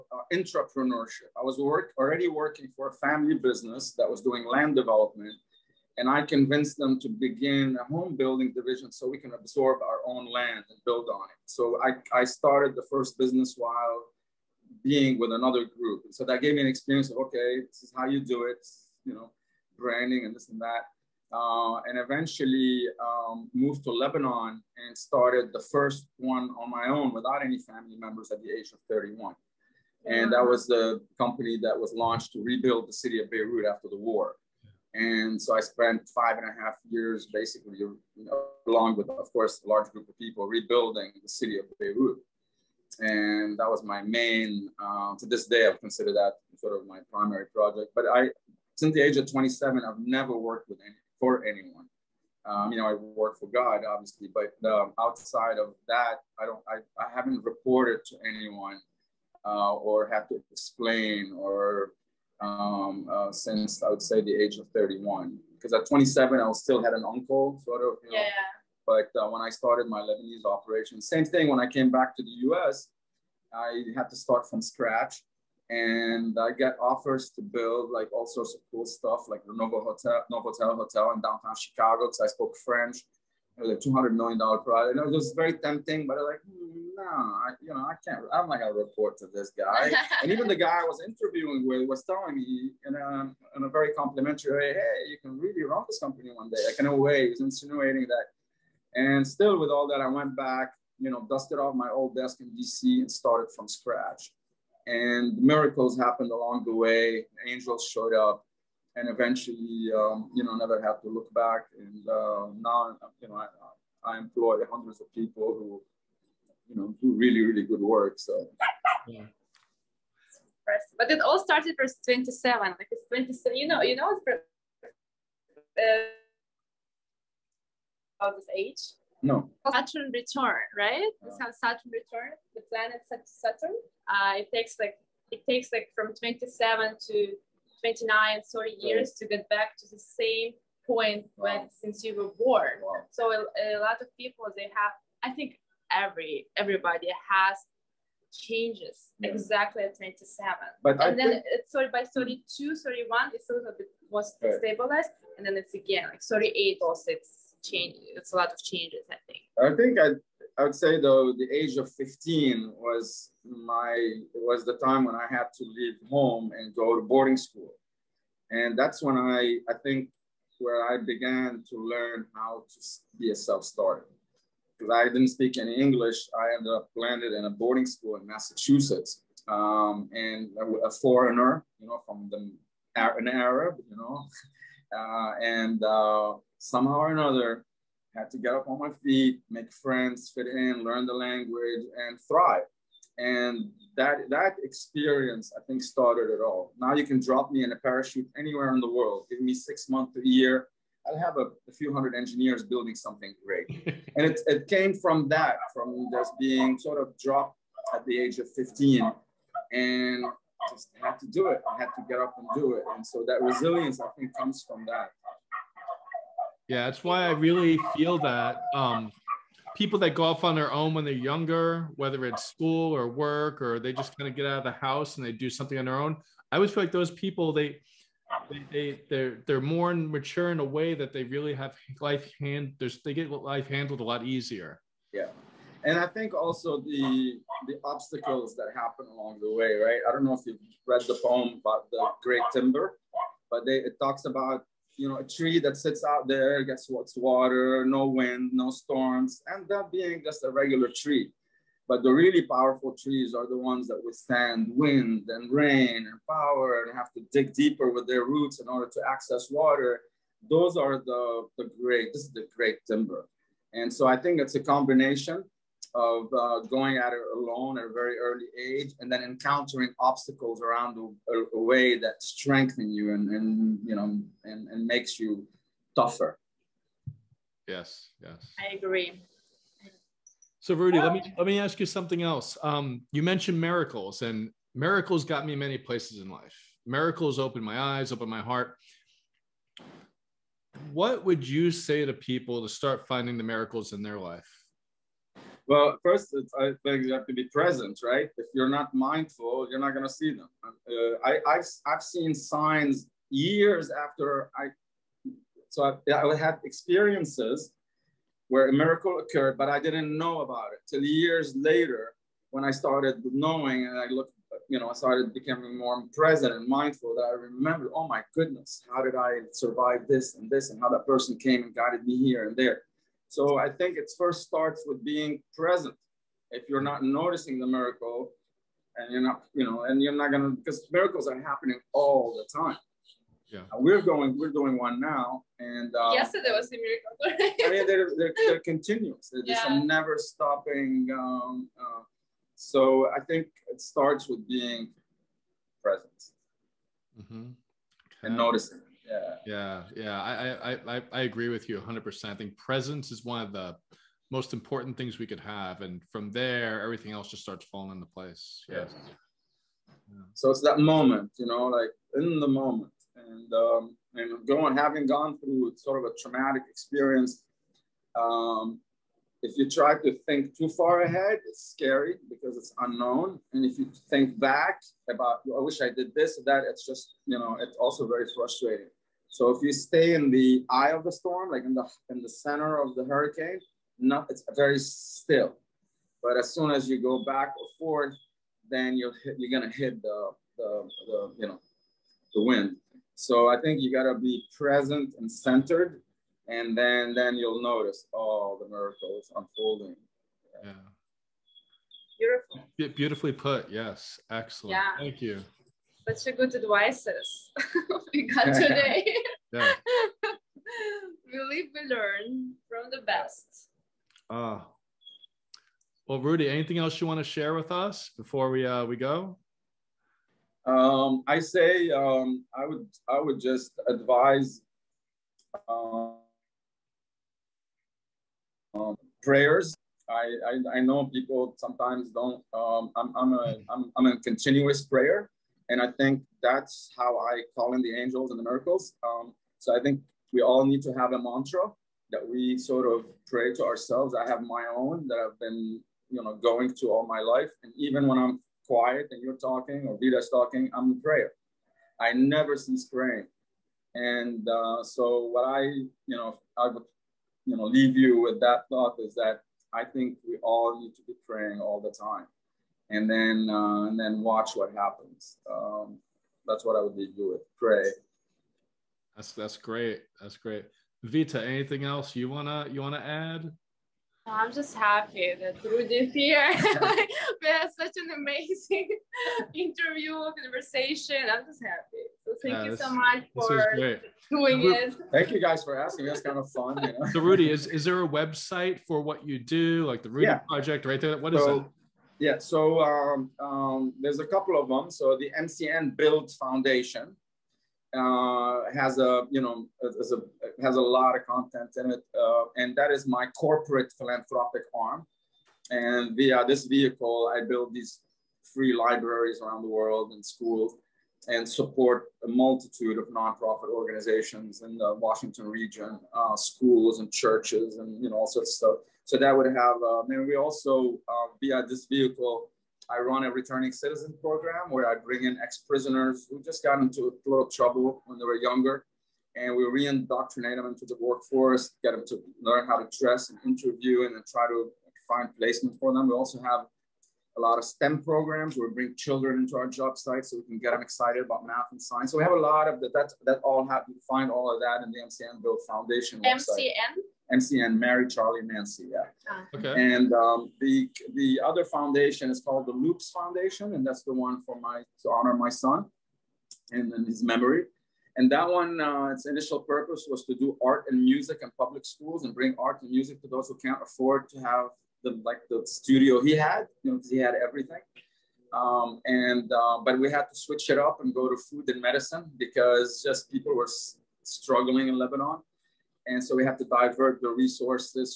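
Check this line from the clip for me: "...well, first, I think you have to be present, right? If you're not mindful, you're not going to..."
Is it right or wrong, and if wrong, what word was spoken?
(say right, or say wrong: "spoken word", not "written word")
right.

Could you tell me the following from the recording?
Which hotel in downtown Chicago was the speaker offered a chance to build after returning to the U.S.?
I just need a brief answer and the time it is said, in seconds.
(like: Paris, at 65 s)
Novotel, at 79 s.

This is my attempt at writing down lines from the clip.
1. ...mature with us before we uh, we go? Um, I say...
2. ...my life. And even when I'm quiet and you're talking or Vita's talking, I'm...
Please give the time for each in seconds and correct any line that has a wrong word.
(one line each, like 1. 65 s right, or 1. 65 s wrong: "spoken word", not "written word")
1. 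417 s wrong: "share", not "mature"
2. 447 s right.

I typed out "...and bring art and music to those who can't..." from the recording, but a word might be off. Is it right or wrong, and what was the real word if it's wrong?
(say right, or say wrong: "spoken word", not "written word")
right.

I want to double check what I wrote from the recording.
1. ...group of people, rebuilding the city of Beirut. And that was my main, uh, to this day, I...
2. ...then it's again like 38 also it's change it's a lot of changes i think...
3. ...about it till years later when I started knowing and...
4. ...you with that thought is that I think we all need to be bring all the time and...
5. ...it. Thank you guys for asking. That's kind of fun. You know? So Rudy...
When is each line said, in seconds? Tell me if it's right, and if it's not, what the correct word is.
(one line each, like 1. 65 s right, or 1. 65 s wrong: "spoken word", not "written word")
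1. 39 s right
2. 155 s right
3. 310 s right
4. 457 s wrong: "praying", not "bring"
5. 484 s right.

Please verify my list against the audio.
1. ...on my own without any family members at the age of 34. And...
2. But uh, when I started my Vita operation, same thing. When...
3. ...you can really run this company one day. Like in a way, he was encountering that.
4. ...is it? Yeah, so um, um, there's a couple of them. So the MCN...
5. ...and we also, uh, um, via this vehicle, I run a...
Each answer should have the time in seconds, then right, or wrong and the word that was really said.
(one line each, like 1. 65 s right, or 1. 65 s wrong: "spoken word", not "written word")
1. 26 s wrong: "31", not "34"
2. 68 s wrong: "Lebanese", not "Vita"
3. 95 s wrong: "insinuating", not "encountering"
4. 491 s right
5. 520 s right.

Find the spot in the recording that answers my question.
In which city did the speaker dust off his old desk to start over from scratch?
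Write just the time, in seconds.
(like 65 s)
101 s.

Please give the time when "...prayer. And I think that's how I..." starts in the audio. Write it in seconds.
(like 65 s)
434 s.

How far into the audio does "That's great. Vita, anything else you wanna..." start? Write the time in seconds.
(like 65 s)
470 s.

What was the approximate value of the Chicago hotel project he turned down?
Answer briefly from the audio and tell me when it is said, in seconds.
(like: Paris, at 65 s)
$200 million, at 83 s.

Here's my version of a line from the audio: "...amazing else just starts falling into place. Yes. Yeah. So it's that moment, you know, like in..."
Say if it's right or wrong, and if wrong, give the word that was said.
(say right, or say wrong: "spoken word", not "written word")
wrong: "everything", not "amazing".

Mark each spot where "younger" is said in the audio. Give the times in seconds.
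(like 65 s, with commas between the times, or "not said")
221 s, 528 s.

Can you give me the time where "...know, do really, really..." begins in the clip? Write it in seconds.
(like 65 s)
116 s.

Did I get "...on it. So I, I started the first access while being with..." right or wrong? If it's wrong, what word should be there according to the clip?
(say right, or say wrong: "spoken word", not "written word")
wrong: "business", not "access".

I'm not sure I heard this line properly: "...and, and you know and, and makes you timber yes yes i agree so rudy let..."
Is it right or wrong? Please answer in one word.
wrong.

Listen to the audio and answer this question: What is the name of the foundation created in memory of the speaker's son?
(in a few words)
Loops Foundation.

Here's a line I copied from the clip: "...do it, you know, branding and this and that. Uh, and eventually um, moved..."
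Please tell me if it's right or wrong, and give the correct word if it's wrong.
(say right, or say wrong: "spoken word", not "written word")
right.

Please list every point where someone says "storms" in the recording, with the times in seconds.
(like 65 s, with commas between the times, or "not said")
248 s, 381 s.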